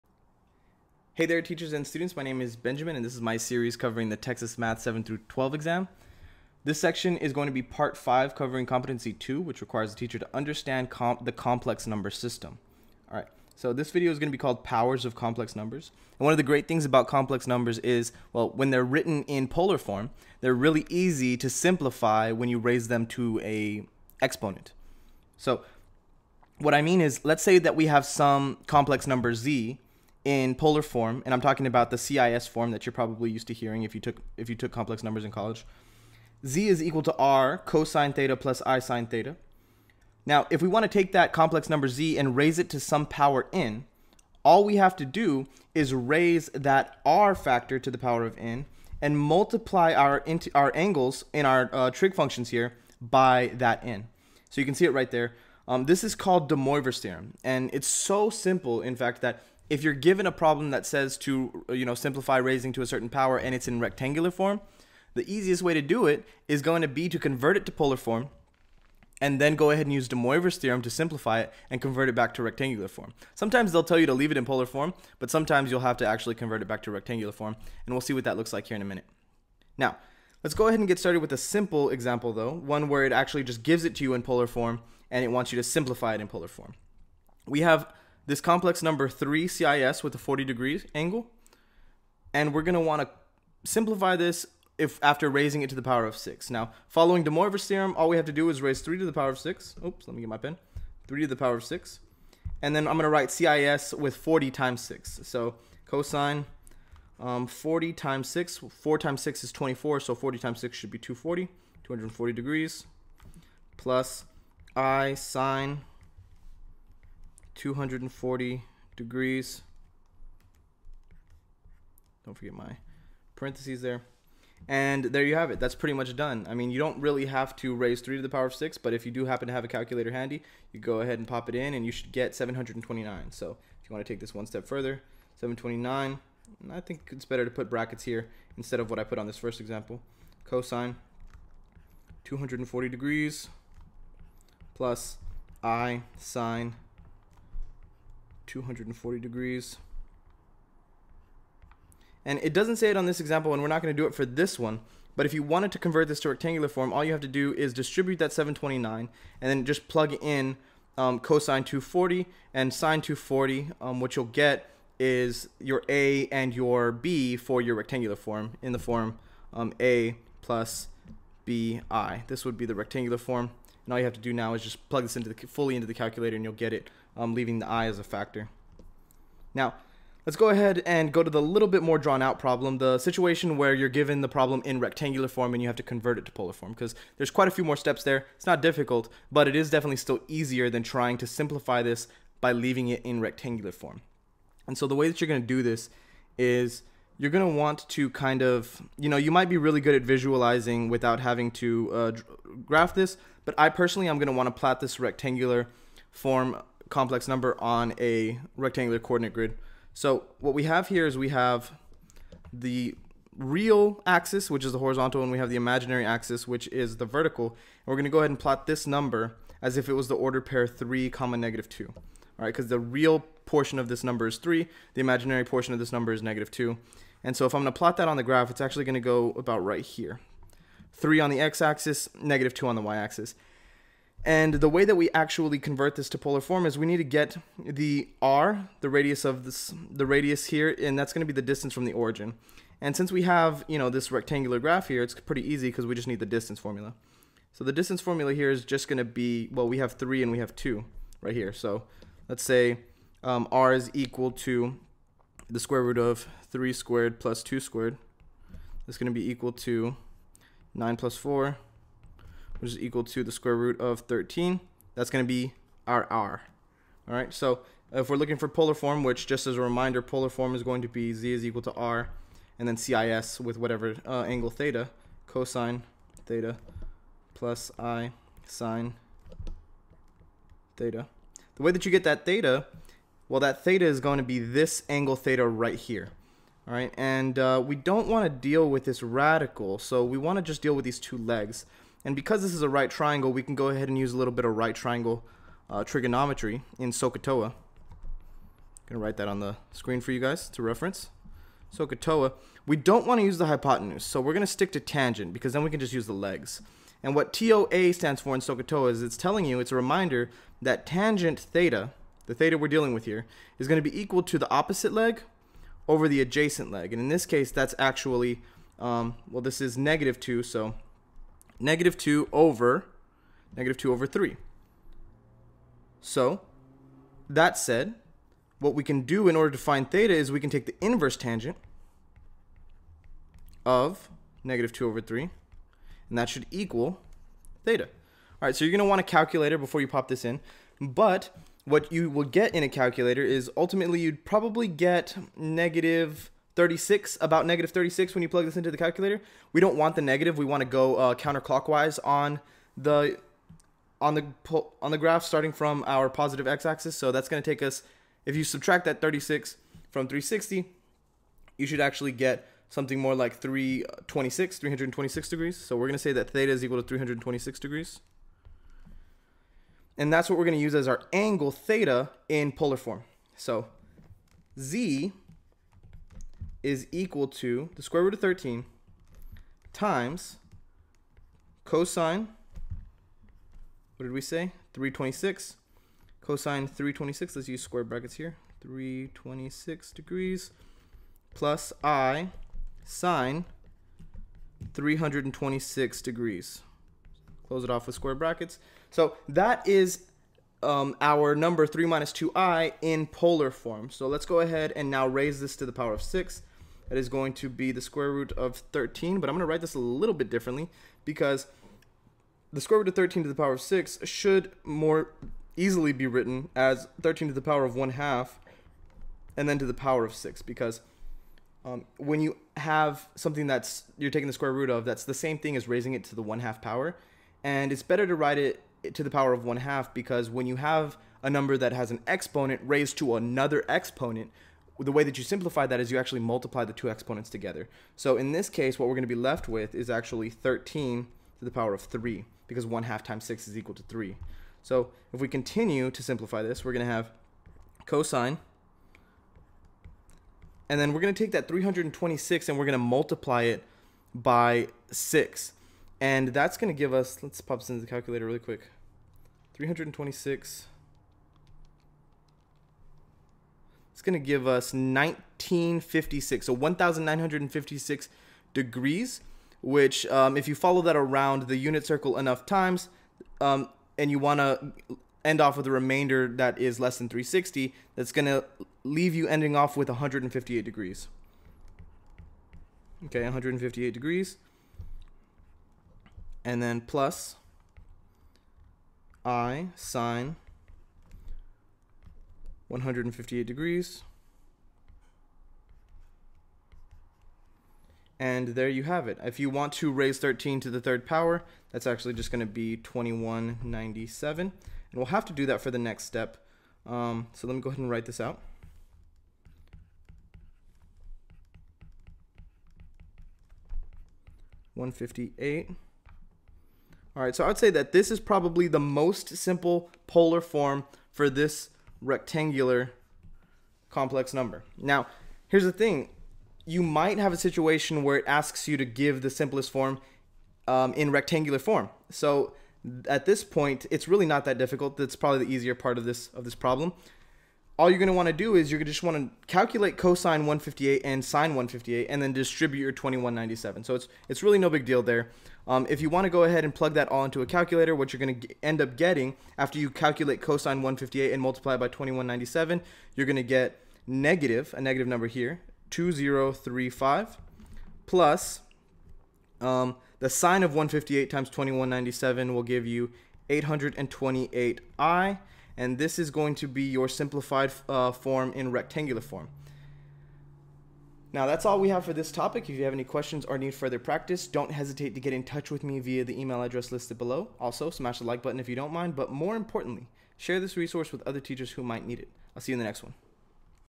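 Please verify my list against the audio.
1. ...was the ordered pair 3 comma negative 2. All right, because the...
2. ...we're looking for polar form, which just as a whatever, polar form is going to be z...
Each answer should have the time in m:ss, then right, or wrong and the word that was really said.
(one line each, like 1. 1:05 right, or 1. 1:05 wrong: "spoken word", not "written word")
1. 3:39 right
2. 4:28 wrong: "reminder", not "whatever".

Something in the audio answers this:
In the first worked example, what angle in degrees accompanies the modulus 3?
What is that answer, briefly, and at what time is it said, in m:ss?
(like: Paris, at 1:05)
40 degrees, at 1:30.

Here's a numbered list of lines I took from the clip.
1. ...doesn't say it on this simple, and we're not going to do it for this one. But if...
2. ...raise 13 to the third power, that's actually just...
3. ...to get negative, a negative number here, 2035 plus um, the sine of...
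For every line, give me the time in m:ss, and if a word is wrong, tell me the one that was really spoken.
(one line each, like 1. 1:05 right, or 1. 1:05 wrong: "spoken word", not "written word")
1. 2:32 wrong: "example", not "simple"
2. 8:19 right
3. 9:13 right.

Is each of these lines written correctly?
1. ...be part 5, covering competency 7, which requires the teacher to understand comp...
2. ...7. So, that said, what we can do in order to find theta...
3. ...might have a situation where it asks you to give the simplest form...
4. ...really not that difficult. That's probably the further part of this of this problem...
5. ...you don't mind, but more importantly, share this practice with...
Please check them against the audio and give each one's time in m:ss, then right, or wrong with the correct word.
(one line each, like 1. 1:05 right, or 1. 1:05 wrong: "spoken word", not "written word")
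1. 0:07 wrong: "2", not "7"
2. 5:24 wrong: "3", not "7"
3. 8:46 right
4. 8:54 wrong: "easier", not "further"
5. 9:38 wrong: "resource", not "practice".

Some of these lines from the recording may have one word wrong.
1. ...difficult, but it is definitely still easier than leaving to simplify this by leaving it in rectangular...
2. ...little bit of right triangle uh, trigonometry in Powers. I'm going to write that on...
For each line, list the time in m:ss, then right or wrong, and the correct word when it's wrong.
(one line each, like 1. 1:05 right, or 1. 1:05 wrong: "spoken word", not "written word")
1. 3:08 wrong: "trying", not "leaving"
2. 4:54 wrong: "SOHCAHTOA", not "Powers".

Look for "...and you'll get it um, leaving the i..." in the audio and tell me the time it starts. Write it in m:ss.
2:56.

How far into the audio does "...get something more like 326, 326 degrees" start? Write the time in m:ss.
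6:02.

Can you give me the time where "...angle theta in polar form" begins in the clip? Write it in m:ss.
6:11.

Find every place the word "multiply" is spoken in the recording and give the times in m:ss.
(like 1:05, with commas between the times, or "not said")
0:49, 7:16, 7:32, 9:11.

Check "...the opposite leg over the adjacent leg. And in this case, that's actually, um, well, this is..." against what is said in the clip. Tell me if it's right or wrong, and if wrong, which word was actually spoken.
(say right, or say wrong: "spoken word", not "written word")
right.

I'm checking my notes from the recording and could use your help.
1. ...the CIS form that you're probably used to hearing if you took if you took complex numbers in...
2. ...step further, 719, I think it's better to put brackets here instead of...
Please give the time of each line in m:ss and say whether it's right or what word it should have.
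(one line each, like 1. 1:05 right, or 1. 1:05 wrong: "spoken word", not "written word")
1. 0:31 right
2. 2:14 wrong: "729", not "719".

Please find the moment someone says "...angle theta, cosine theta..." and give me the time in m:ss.
4:34.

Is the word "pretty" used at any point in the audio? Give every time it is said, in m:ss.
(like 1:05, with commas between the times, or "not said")
2:05, 4:05.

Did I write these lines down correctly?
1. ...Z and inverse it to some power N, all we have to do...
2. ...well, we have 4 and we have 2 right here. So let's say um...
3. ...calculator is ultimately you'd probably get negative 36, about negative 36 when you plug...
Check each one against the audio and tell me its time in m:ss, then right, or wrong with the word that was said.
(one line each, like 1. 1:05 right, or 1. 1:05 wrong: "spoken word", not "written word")
1. 0:41 wrong: "raise", not "inverse"
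2. 4:09 wrong: "3", not "4"
3. 5:42 right.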